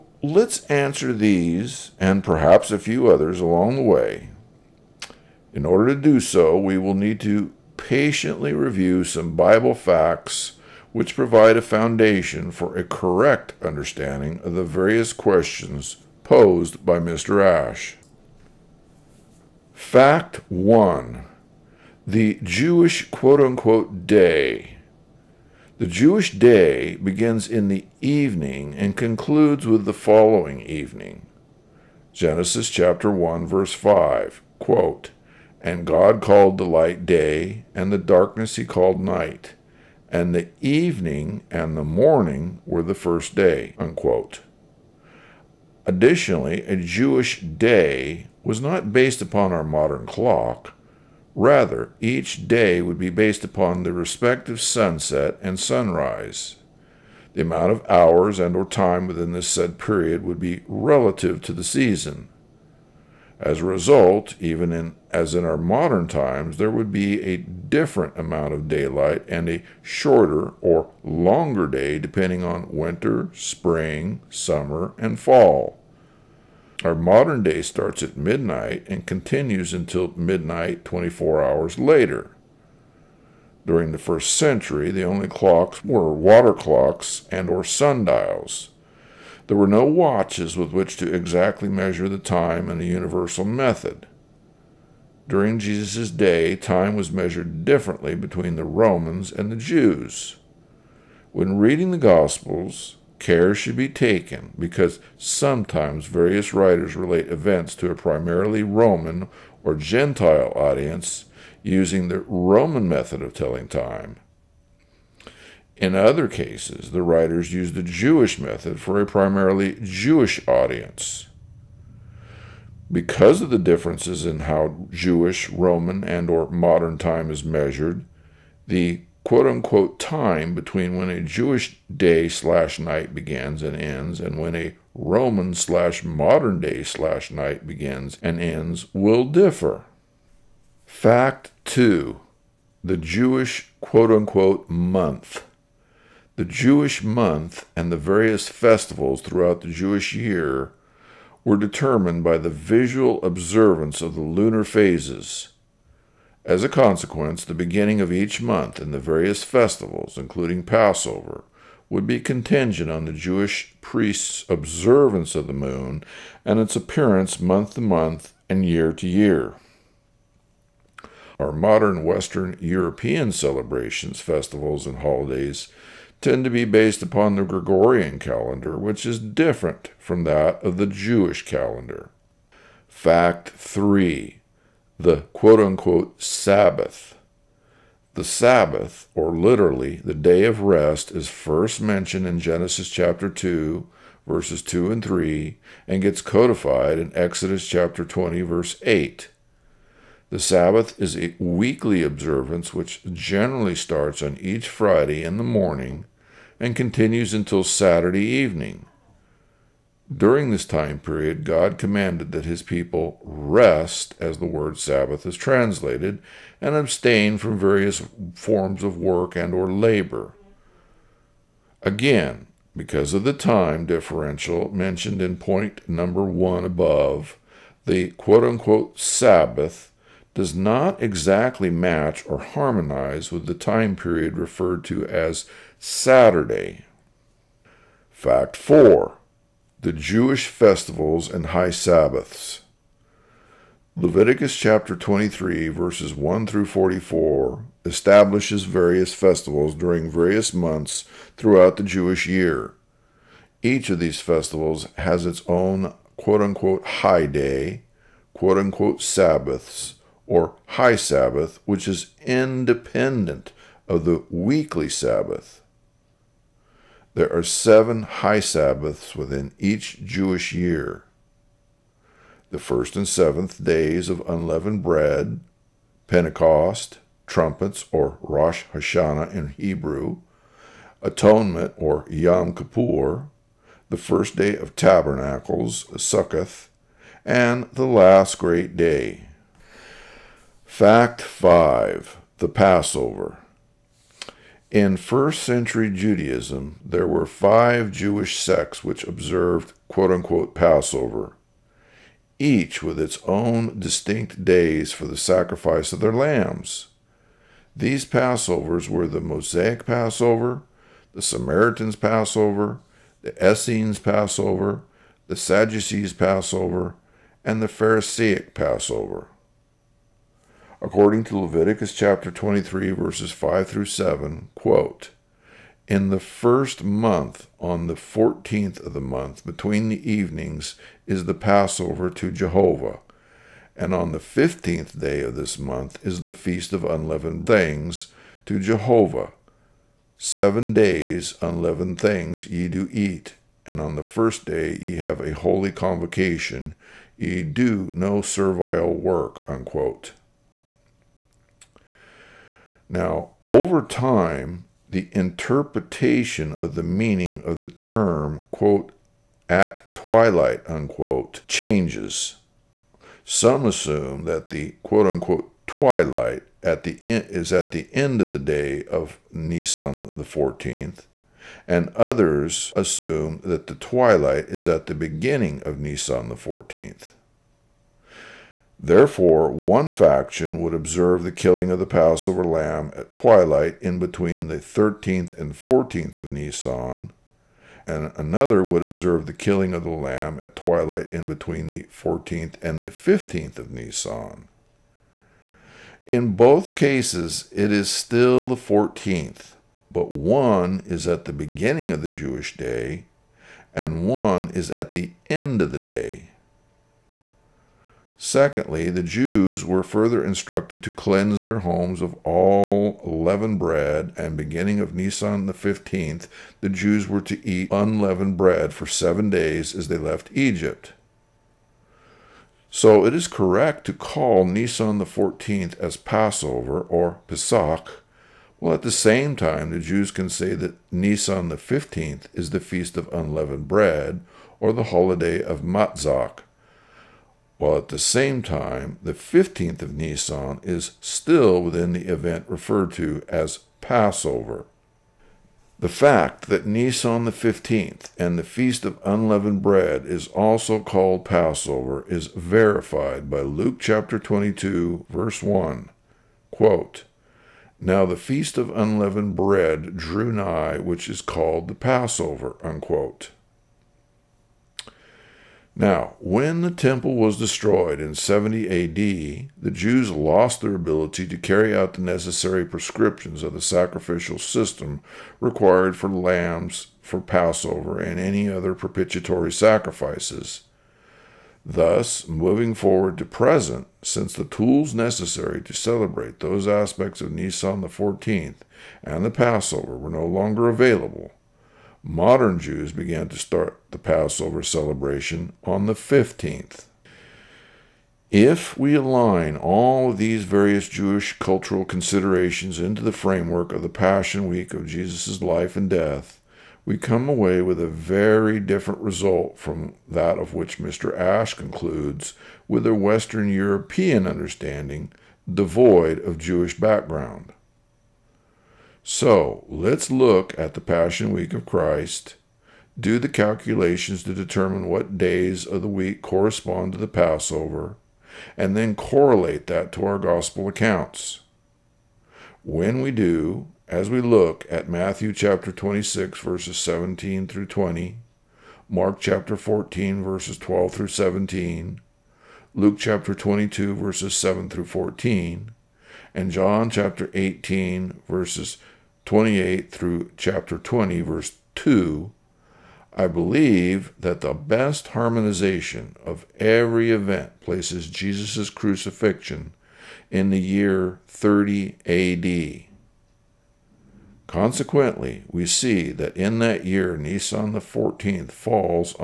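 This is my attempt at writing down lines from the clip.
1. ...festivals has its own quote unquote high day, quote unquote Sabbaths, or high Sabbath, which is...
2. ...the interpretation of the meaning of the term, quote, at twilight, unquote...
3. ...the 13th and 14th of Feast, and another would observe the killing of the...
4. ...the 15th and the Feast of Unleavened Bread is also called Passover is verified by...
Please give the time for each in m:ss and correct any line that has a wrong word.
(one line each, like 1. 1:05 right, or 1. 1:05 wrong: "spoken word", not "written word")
1. 4:14 right
2. 5:54 right
3. 6:24 wrong: "Nisan", not "Feast"
4. 7:27 right.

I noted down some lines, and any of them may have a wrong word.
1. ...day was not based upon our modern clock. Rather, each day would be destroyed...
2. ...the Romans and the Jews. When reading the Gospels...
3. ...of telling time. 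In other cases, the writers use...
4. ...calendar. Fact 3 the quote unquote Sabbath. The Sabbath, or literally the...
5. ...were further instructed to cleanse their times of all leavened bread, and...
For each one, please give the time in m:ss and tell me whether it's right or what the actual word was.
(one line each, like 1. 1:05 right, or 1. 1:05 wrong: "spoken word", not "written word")
1. 0:47 wrong: "based", not "destroyed"
2. 1:38 right
3. 1:53 right
4. 3:01 right
5. 6:49 wrong: "homes", not "times".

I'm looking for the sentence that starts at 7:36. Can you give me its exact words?
Quote, now the Feast of Unleavened Bread drew nigh, which is called the Passover.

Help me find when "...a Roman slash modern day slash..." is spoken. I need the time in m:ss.
2:14.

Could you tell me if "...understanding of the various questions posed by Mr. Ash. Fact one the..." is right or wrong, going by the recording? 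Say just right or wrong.
right.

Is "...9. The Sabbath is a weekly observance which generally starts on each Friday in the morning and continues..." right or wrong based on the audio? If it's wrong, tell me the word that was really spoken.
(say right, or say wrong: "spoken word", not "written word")
wrong: "8", not "9".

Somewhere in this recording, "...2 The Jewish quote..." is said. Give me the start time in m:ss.
2:21.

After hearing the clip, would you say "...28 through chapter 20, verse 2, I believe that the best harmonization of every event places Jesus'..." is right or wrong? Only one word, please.
right.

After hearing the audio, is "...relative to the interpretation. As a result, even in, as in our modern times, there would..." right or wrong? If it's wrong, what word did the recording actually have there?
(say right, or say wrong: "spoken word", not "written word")
wrong: "season", not "interpretation".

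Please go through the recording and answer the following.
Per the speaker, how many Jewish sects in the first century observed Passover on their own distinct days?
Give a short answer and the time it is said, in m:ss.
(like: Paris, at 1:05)
5, at 4:57.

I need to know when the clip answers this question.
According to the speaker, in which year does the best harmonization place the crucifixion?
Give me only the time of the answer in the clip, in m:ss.
9:21.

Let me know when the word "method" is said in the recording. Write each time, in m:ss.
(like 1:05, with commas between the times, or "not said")
1:33, 1:52, 1:58.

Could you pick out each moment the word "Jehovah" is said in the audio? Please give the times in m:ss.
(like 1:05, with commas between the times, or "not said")
5:32, 5:38.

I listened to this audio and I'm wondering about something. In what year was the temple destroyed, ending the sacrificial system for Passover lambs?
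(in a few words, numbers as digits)
70 AD.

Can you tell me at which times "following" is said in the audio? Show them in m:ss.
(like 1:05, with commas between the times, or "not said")
0:29.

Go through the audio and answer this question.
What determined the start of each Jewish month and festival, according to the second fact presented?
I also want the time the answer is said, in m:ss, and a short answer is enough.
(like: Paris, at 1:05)
Lunar phases, at 2:34.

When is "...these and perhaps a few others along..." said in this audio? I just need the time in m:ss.
0:01.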